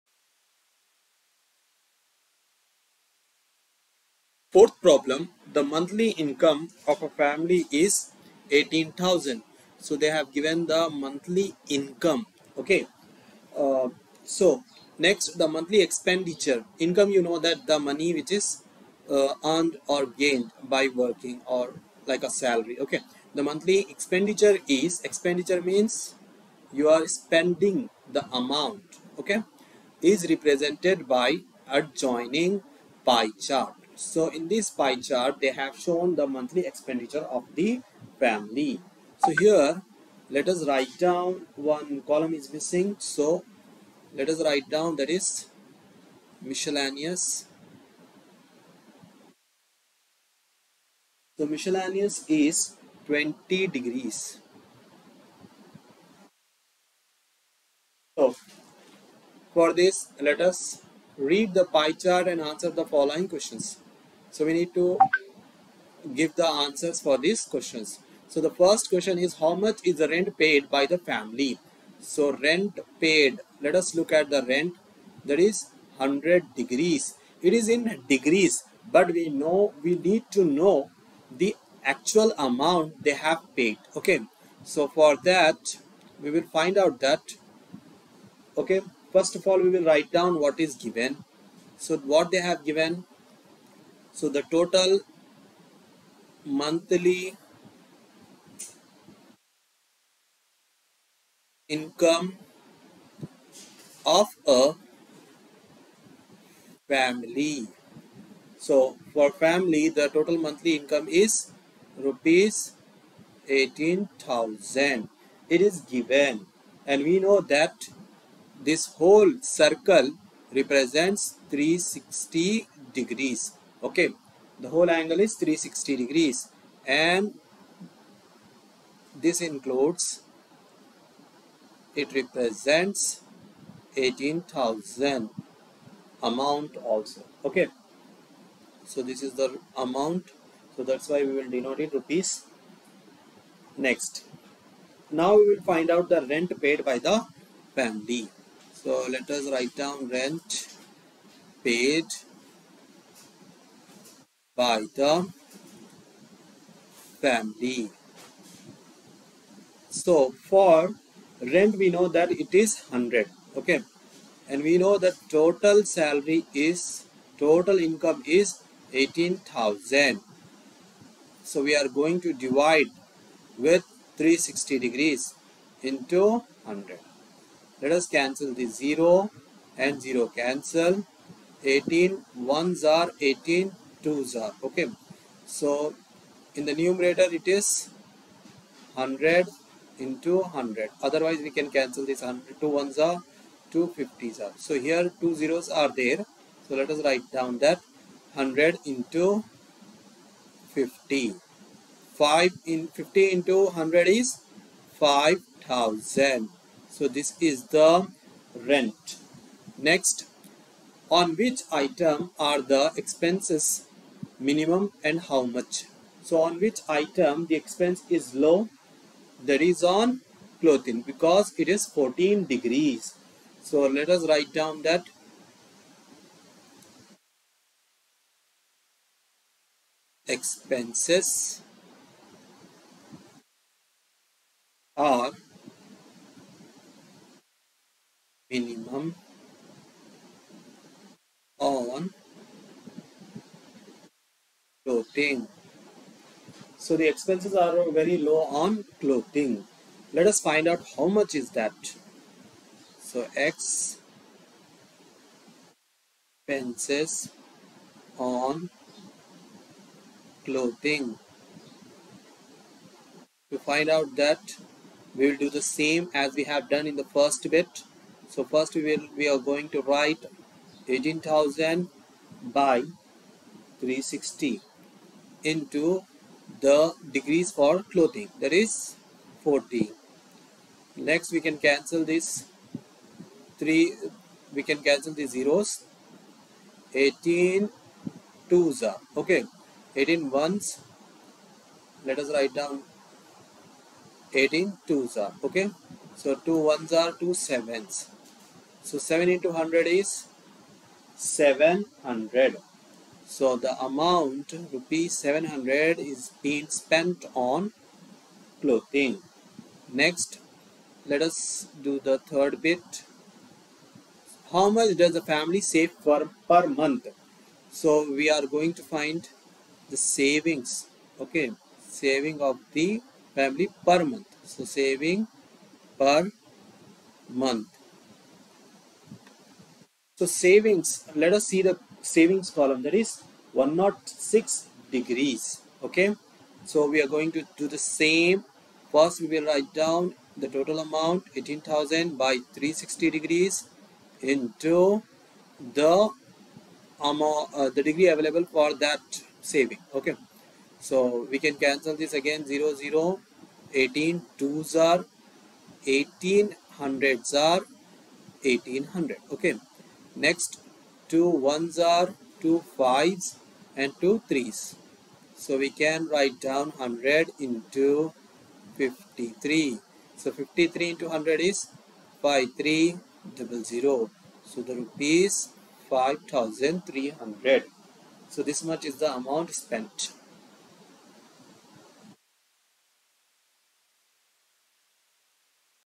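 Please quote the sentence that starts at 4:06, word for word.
So the expenses are very low on clothing.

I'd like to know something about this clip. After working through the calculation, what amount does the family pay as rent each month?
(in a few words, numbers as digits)
5000.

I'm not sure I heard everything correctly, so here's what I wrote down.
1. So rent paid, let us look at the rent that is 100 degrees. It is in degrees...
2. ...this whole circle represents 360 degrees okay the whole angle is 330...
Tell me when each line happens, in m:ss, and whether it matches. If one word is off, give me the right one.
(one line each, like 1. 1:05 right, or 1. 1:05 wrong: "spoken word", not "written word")
1. 1:11 right
2. 1:58 wrong: "360", not "330".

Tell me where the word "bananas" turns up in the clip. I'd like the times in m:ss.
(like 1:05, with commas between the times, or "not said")
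not said.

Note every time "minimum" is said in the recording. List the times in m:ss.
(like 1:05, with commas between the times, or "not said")
3:34, 3:58.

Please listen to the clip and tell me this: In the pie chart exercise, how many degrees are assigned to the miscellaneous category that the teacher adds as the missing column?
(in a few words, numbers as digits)
20 degrees.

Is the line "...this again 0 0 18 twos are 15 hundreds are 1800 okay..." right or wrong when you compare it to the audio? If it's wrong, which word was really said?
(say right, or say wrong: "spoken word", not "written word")
wrong: "18", not "15".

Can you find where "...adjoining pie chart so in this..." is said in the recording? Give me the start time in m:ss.
0:31.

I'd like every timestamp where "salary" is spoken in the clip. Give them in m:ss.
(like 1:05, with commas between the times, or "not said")
0:22, 2:45.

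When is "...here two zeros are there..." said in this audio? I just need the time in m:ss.
3:14.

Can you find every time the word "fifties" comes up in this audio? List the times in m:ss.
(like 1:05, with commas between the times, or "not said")
3:13.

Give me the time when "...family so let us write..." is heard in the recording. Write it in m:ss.
2:27.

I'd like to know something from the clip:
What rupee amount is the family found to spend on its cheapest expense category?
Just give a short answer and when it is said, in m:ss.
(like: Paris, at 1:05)
700, at 5:04.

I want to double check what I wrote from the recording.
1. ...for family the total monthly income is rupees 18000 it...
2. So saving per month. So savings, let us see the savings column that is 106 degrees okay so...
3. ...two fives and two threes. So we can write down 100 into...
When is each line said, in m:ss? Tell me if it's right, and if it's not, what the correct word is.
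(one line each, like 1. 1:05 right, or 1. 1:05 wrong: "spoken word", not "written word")
1. 1:49 right
2. 5:24 right
3. 6:02 right.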